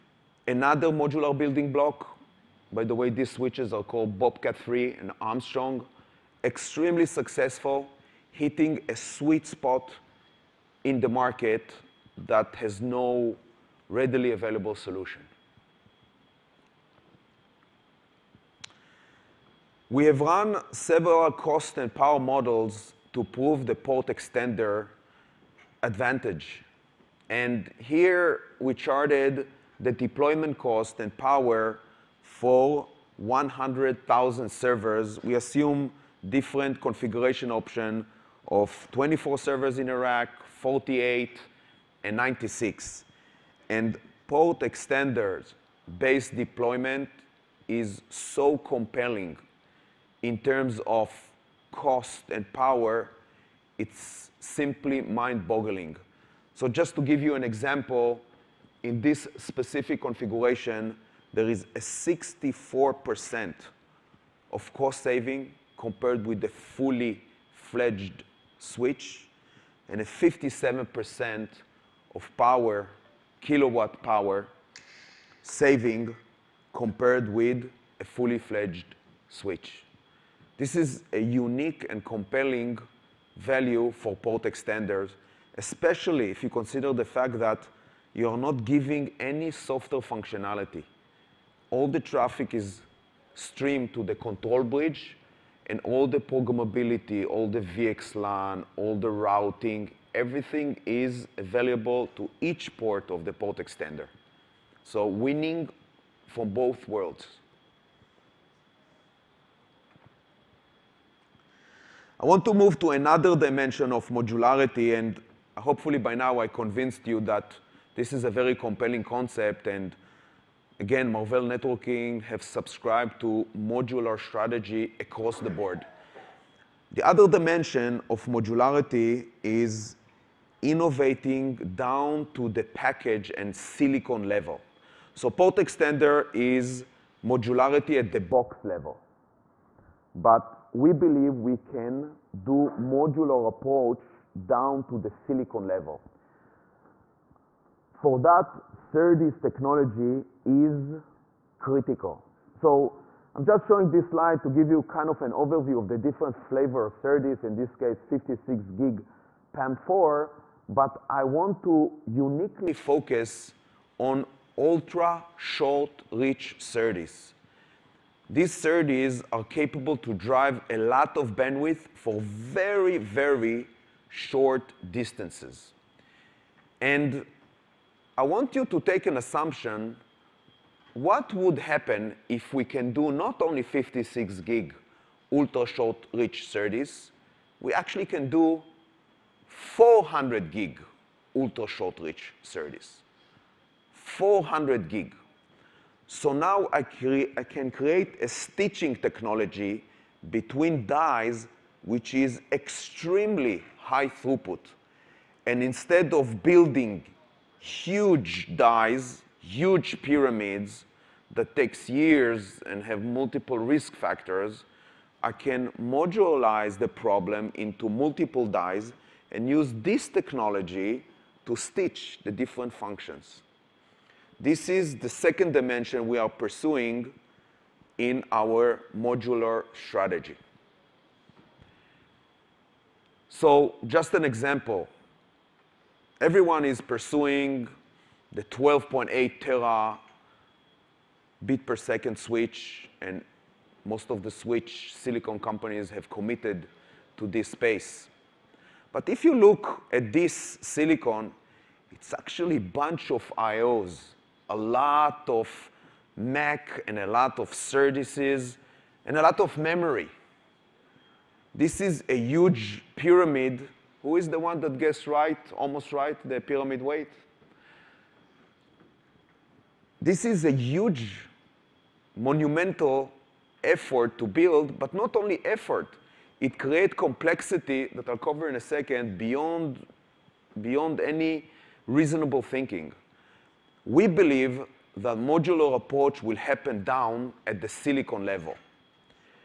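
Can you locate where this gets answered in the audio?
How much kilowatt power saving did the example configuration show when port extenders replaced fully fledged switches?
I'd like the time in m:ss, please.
1:10.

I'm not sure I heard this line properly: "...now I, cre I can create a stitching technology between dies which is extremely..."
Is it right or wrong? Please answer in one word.
right.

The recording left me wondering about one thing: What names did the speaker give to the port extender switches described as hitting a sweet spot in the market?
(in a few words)
Bobcat 3 and Armstrong.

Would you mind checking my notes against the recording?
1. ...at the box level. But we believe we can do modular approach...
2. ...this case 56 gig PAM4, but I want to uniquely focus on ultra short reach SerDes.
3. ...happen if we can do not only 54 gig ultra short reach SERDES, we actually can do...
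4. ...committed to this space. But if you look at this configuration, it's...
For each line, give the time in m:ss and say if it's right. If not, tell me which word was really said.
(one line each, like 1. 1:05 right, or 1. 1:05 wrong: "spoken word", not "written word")
1. 2:17 right
2. 2:37 right
3. 3:01 wrong: "56", not "54"
4. 4:06 wrong: "silicon", not "configuration".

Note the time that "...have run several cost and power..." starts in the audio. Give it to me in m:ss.
0:20.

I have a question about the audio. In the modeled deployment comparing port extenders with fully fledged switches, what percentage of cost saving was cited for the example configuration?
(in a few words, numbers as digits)
64%.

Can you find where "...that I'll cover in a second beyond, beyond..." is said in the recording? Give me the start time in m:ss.
4:37.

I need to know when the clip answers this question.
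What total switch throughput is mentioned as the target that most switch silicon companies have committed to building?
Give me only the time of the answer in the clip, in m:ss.
3:58.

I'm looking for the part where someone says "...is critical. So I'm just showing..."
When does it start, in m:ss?
2:30.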